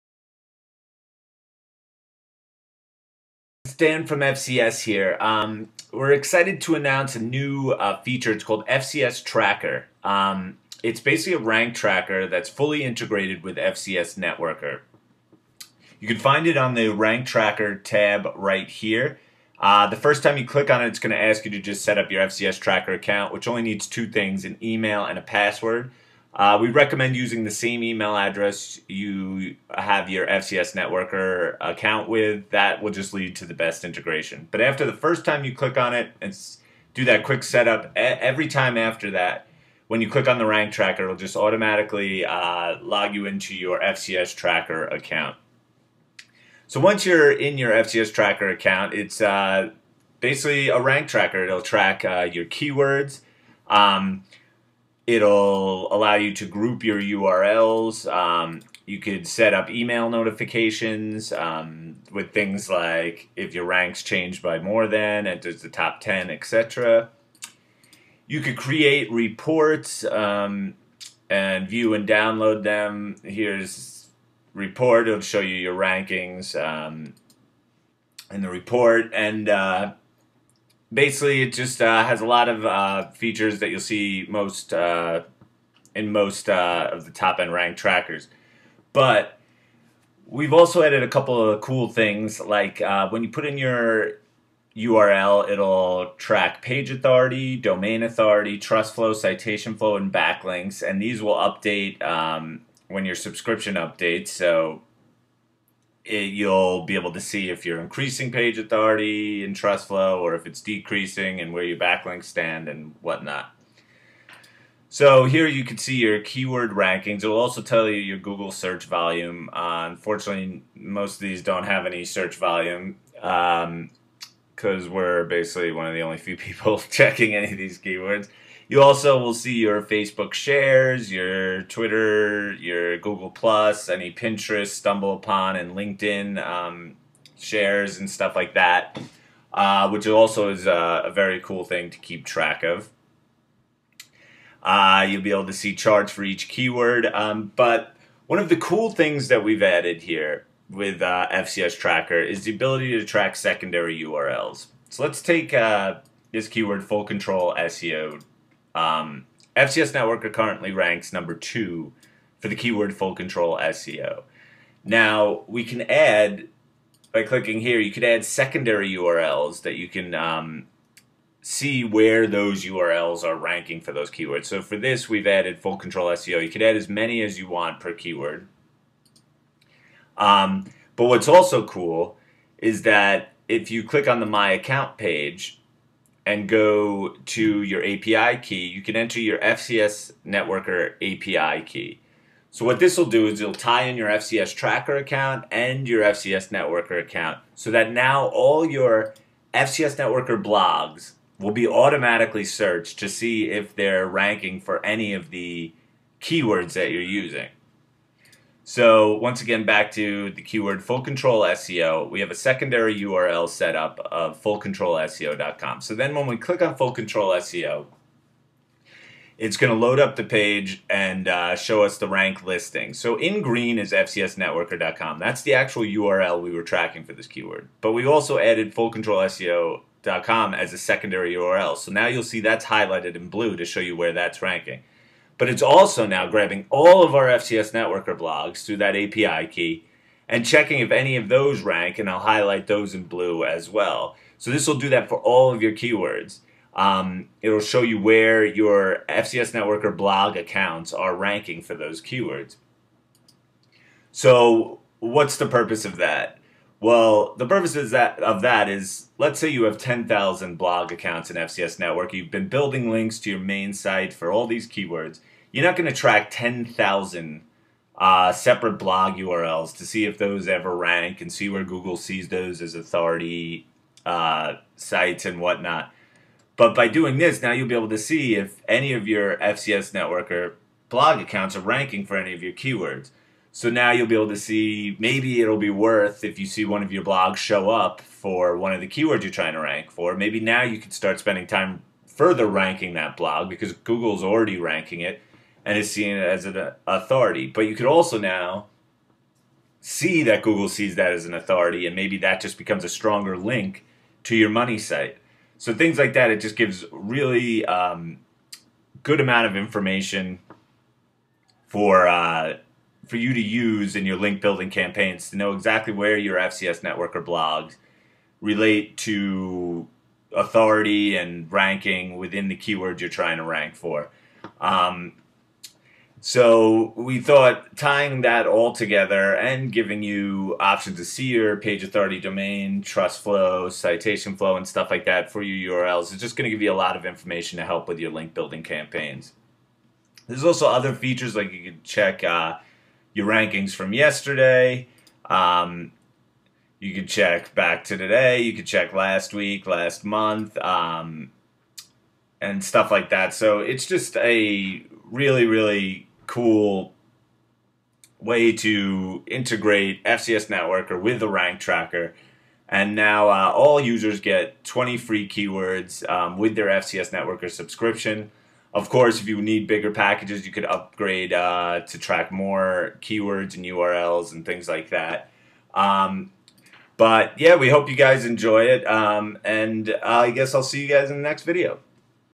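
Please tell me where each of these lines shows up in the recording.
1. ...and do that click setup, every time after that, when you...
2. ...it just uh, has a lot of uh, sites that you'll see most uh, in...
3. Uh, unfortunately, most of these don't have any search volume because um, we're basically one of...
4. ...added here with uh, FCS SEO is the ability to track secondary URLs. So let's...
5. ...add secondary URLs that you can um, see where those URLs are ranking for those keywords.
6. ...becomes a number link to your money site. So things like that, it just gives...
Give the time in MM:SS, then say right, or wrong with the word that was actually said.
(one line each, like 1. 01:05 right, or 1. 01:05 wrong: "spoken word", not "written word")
1. 00:36 wrong: "quick", not "click"
2. 01:21 wrong: "features", not "sites"
3. 01:59 right
4. 02:29 wrong: "Tracker", not "SEO"
5. 02:48 right
6. 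05:02 wrong: "stronger", not "number".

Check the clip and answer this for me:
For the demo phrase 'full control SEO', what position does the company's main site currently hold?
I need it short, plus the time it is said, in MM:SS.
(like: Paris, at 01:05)
Number 2, at 02:41.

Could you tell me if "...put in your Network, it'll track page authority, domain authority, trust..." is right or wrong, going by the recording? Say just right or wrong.
wrong.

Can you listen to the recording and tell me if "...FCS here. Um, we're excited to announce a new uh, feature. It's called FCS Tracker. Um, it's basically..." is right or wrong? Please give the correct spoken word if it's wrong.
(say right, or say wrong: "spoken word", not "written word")
right.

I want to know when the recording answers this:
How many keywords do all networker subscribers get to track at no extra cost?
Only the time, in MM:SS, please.
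06:04.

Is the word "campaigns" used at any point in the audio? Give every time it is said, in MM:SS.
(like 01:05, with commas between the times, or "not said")
05:14, 05:38.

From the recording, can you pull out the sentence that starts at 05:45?
Um, you can check back to today.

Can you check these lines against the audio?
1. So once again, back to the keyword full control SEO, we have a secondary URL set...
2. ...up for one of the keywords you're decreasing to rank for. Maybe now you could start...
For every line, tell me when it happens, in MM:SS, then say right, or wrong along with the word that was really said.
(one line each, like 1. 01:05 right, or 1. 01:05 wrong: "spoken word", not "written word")
1. 03:28 right
2. 04:47 wrong: "trying", not "decreasing".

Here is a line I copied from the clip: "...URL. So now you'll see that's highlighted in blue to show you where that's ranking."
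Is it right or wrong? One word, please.
right.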